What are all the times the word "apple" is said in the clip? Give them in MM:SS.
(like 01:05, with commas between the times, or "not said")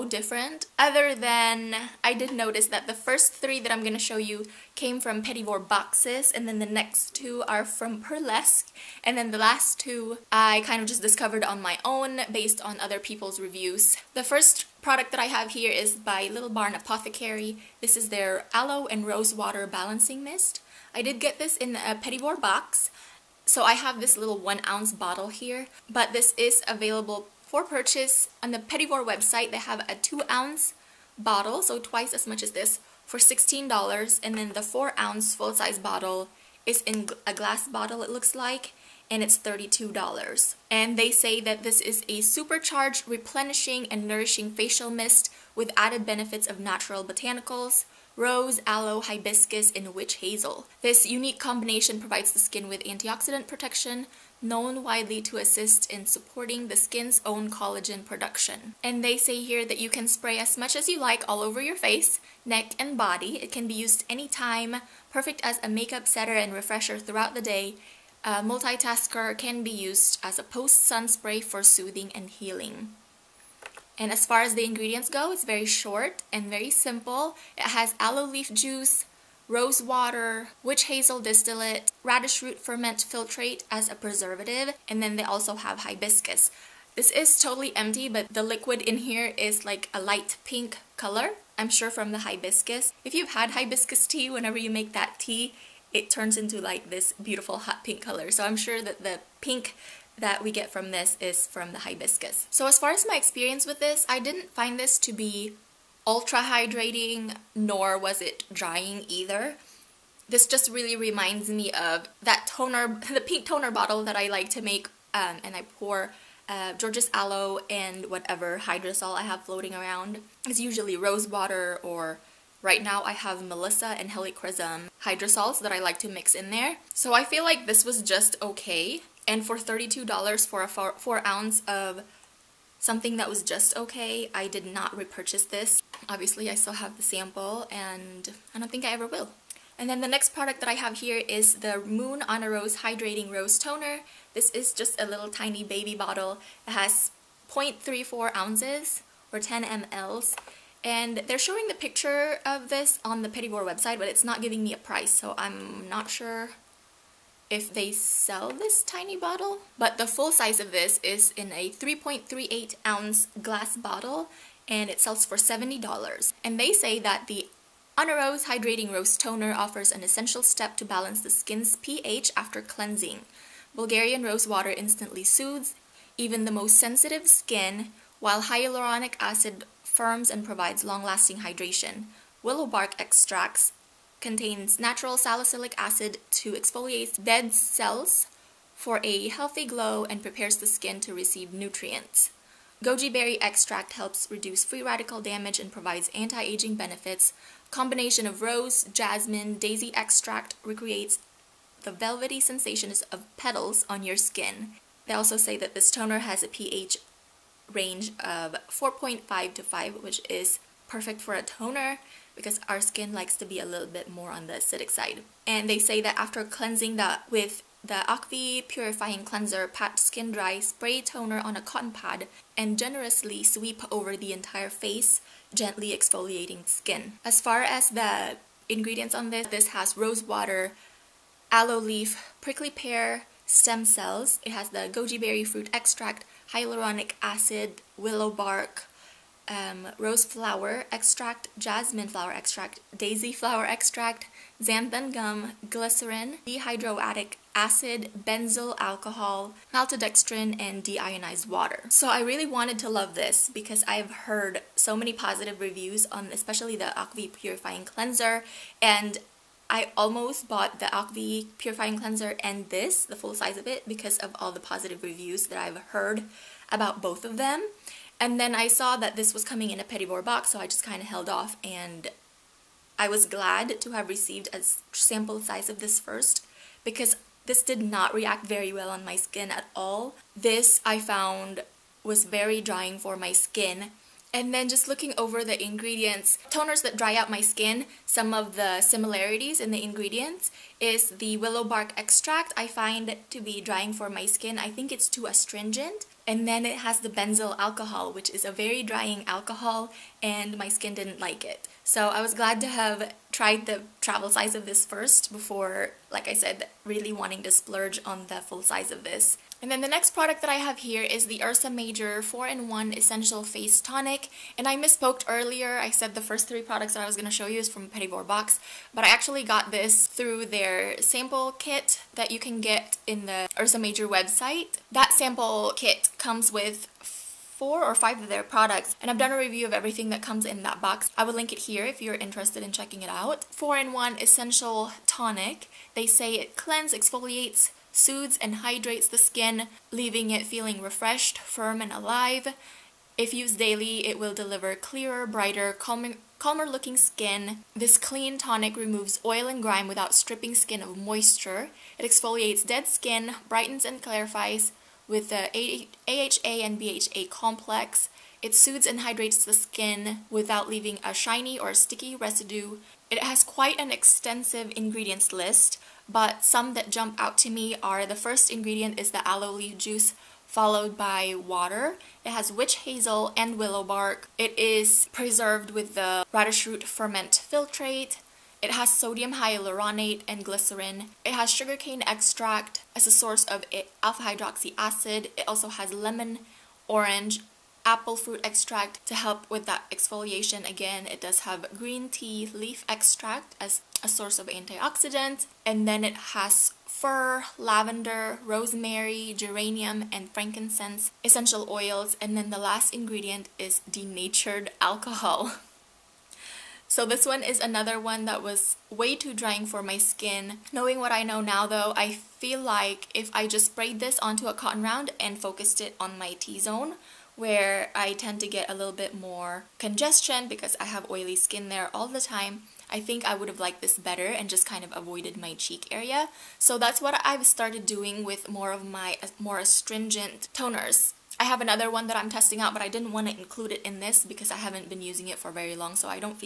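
06:27.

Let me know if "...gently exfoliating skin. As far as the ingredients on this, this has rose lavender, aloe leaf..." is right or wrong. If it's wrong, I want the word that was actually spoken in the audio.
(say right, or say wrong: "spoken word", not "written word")
wrong: "water", not "lavender".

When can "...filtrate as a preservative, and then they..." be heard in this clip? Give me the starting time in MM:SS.
01:22.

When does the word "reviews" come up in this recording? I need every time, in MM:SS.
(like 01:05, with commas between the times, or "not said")
00:13, 04:15, 04:25, 05:29.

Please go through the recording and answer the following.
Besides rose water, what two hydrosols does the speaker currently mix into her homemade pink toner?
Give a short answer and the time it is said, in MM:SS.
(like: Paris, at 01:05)
Melissa and Helichrysum, at 02:03.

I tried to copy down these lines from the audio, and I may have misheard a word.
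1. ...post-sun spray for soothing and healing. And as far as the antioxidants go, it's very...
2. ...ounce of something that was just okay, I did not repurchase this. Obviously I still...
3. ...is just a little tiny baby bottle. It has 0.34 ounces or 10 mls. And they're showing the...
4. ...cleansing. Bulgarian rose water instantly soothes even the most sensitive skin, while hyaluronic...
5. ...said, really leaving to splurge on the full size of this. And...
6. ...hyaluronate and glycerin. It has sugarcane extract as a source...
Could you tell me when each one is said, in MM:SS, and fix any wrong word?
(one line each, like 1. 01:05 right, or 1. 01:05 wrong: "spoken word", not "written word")
1. 01:10 wrong: "ingredients", not "antioxidants"
2. 02:11 right
3. 02:24 right
4. 02:52 right
5. 05:06 wrong: "wanting", not "leaving"
6. 06:19 right.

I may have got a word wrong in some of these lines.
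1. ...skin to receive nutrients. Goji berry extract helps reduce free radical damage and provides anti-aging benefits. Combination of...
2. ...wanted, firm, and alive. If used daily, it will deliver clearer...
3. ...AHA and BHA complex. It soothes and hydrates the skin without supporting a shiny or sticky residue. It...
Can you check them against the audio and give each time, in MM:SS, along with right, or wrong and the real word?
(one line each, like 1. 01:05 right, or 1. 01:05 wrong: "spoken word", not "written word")
1. 03:10 right
2. 05:40 wrong: "refreshed", not "wanted"
3. 05:56 wrong: "leaving", not "supporting".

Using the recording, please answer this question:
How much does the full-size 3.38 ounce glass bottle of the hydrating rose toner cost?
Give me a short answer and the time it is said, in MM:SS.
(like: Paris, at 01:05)
$70, at 02:45.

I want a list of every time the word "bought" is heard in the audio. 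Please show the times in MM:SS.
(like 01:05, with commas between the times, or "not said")
04:20.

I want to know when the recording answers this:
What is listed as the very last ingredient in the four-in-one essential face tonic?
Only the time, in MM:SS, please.
06:43.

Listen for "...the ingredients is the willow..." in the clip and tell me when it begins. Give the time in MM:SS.
04:49.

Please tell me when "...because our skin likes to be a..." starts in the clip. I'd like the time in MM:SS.
03:32.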